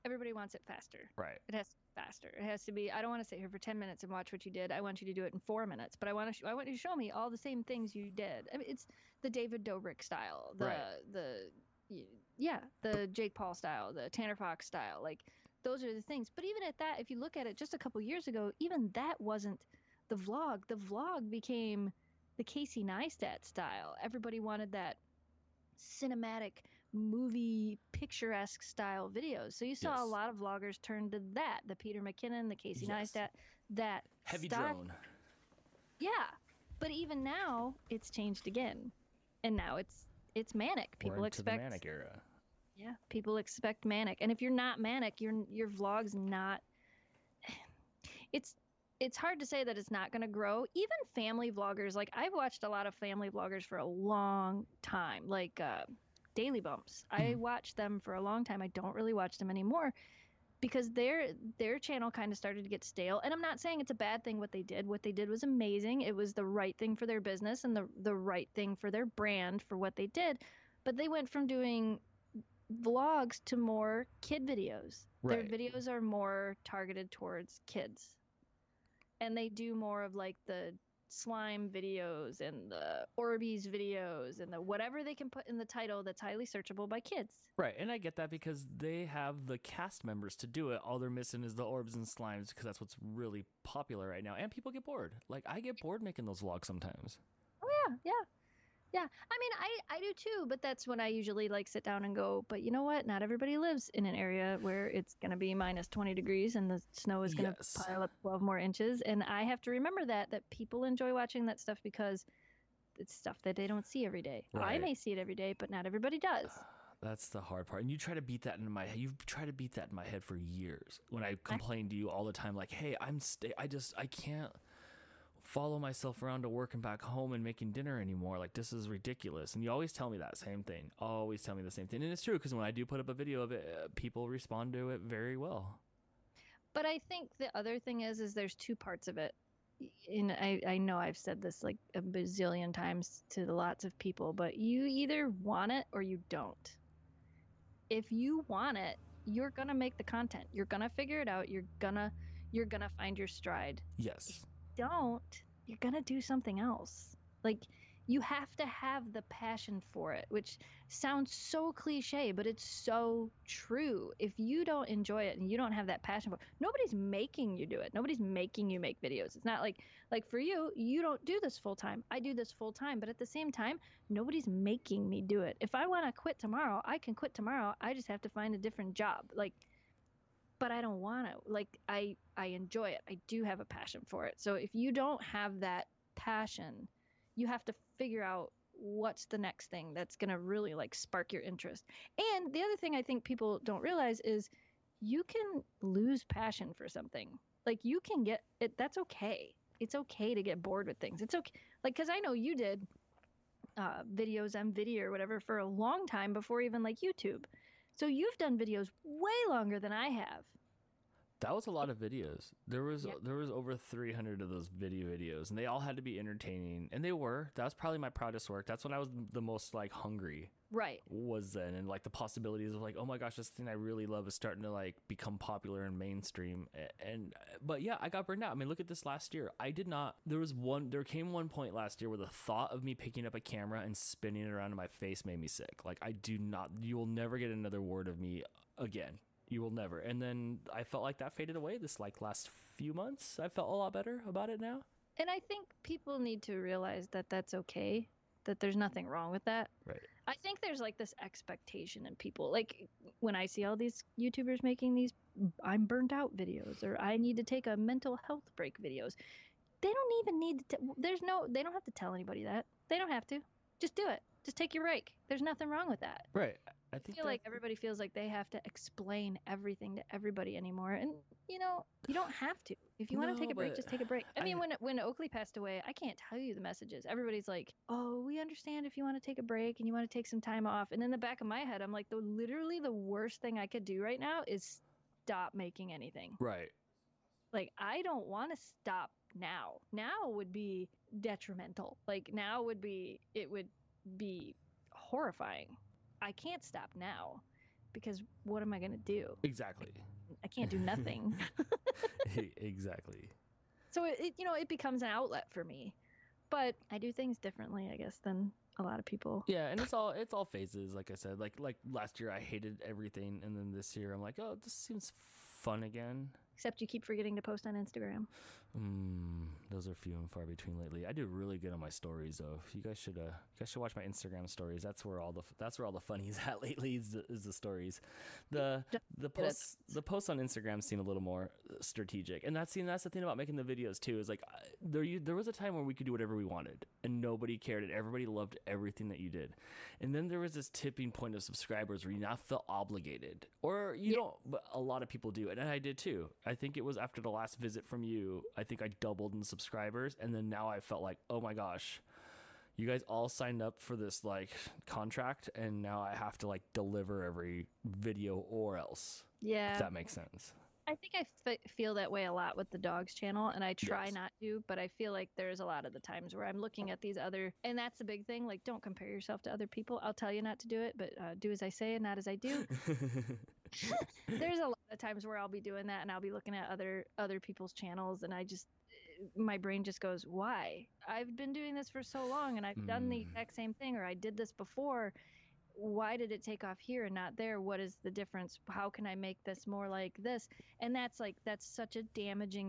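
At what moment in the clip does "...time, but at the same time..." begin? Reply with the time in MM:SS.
02:52.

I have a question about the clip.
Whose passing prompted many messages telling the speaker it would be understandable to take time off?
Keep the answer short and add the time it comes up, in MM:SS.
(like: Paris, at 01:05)
Oakley, at 04:34.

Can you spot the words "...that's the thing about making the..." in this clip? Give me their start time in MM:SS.
05:32.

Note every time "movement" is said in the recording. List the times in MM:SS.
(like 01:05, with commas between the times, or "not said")
not said.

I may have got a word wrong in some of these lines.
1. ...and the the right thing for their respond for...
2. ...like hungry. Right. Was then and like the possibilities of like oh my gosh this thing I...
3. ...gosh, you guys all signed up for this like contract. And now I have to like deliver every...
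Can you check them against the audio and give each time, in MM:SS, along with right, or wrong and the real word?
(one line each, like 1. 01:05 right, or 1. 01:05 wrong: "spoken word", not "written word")
1. 01:07 wrong: "brand", not "respond"
2. 03:39 right
3. 05:51 right.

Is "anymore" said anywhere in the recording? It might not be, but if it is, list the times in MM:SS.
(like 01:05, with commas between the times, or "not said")
00:59, 02:07, 04:30.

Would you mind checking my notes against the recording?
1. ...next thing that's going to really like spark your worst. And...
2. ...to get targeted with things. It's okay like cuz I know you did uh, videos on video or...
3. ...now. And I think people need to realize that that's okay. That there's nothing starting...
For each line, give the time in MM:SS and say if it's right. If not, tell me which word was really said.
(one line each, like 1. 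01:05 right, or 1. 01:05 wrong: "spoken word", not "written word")
1. 03:09 wrong: "interest", not "worst"
2. 03:20 wrong: "bored", not "targeted"
3. 04:04 wrong: "wrong", not "starting".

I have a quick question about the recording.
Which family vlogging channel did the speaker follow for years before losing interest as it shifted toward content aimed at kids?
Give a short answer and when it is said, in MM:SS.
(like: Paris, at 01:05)
Daily Bumps, at 00:56.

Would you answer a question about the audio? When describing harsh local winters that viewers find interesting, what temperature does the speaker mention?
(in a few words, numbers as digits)
-20 degrees.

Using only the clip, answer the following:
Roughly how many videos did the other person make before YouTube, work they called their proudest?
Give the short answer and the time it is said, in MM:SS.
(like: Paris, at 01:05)
over 300, at 03:33.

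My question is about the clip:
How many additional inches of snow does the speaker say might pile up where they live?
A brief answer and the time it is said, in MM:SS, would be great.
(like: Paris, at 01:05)
12, at 01:48.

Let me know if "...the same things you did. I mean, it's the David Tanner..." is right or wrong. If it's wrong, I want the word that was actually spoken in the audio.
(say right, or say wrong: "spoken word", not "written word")
wrong: "Dobrik", not "Tanner".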